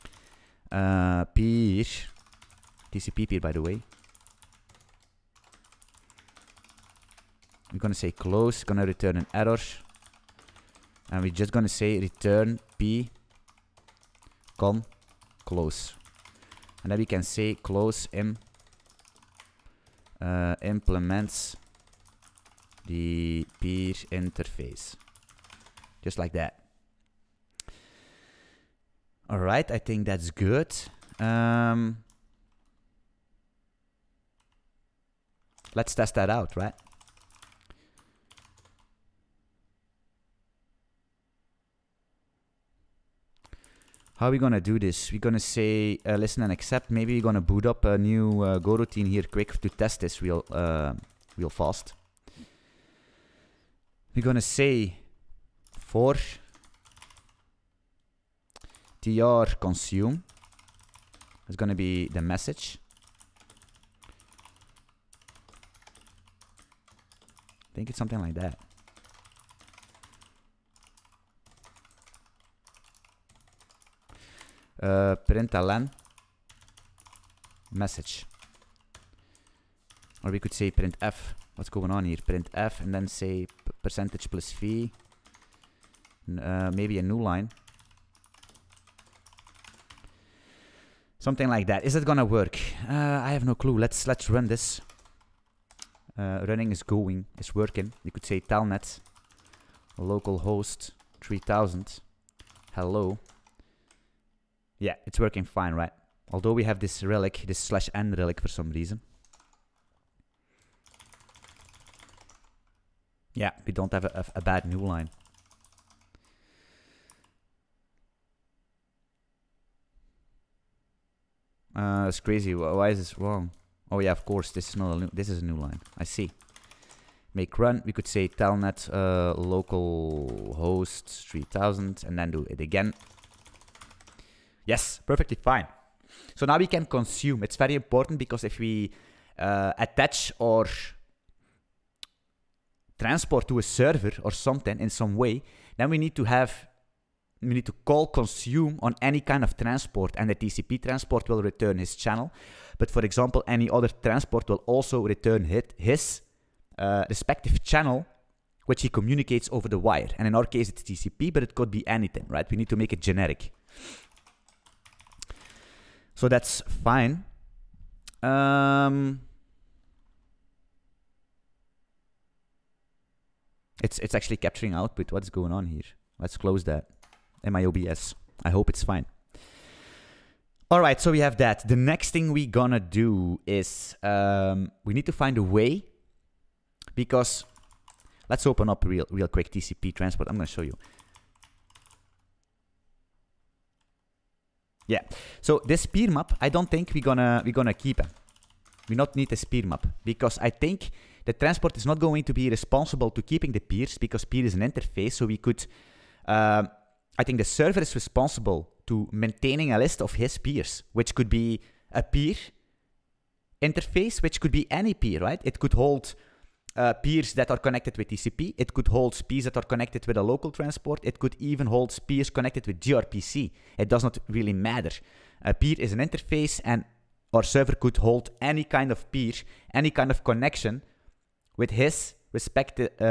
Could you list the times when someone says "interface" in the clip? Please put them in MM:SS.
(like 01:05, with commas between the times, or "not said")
00:24, 03:24, 03:33, 03:45.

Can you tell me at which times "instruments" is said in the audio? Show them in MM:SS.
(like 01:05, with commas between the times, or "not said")
not said.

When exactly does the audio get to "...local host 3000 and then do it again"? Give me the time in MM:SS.
02:09.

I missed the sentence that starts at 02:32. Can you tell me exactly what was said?
But for example, any other transport will also return hit, his uh, respective channel which he communicates over the wire.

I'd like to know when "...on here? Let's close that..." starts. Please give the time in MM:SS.
02:55.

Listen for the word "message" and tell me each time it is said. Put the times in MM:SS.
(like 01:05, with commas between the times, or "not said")
01:02, 01:17.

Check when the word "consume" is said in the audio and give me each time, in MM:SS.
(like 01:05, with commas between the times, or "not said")
00:59, 02:16, 02:28.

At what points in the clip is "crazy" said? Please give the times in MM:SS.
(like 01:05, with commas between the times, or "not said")
02:02.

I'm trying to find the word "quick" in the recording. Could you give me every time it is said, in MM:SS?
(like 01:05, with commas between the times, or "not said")
00:49, 03:09.